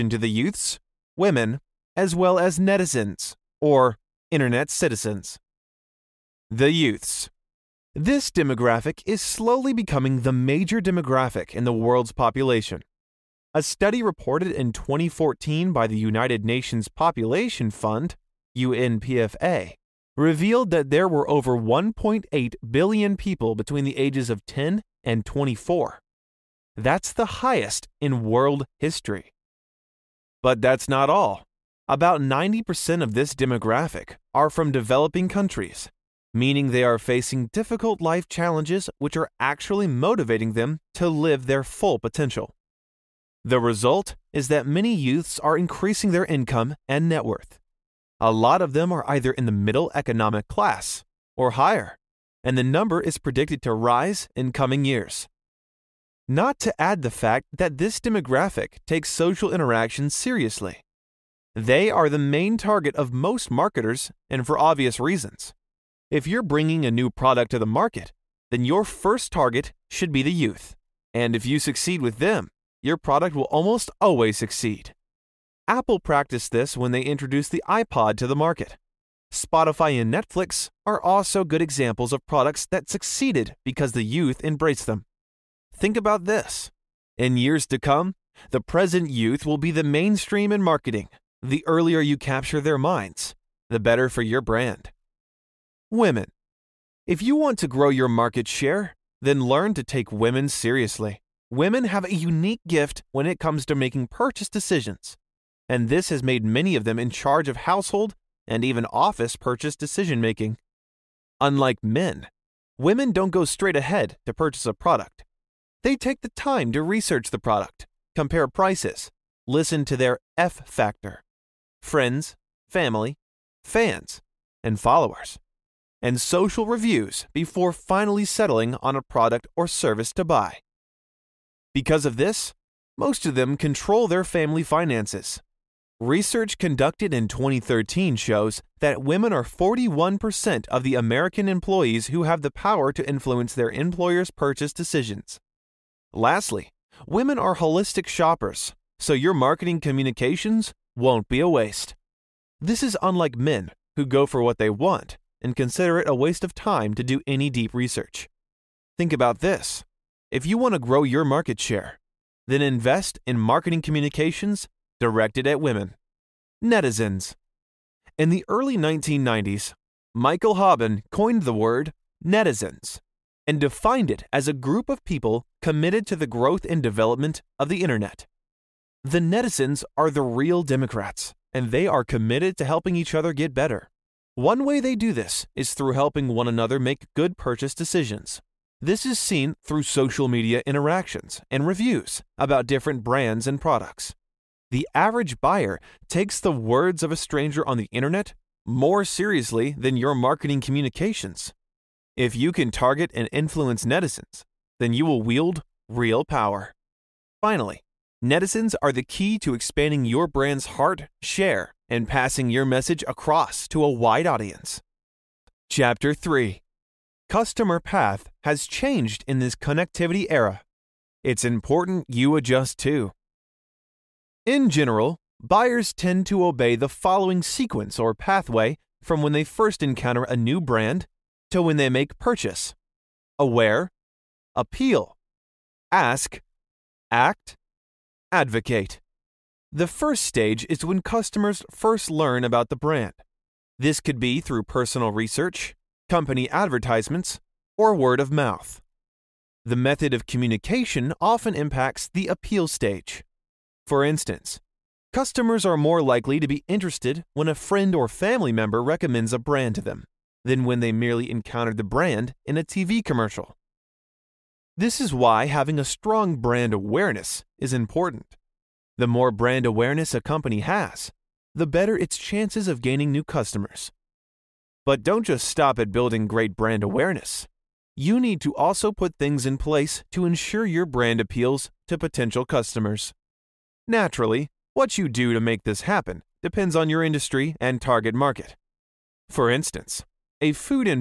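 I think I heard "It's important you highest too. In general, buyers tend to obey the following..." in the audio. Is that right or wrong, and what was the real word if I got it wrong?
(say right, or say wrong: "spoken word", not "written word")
wrong: "adjust", not "highest".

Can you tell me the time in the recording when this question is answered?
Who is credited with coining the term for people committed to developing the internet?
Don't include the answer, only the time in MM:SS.
02:50.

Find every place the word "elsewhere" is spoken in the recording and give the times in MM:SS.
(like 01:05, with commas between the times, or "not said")
not said.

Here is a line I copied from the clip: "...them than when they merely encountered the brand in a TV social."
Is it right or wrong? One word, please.
wrong.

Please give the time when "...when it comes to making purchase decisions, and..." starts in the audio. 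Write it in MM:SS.
01:43.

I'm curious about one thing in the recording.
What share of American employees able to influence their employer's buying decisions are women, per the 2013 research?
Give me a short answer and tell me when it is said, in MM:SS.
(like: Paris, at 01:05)
41%, at 02:19.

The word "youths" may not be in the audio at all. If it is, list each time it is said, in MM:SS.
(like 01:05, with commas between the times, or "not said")
00:00, 00:06, 00:44, 01:10, 01:24, 01:29.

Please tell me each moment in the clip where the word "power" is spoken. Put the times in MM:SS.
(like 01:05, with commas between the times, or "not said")
02:22, 03:26.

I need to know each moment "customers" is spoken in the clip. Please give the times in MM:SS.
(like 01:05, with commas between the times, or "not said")
03:37, 04:01, 04:15, 04:33, 04:42.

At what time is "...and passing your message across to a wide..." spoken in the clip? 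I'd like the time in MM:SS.
03:31.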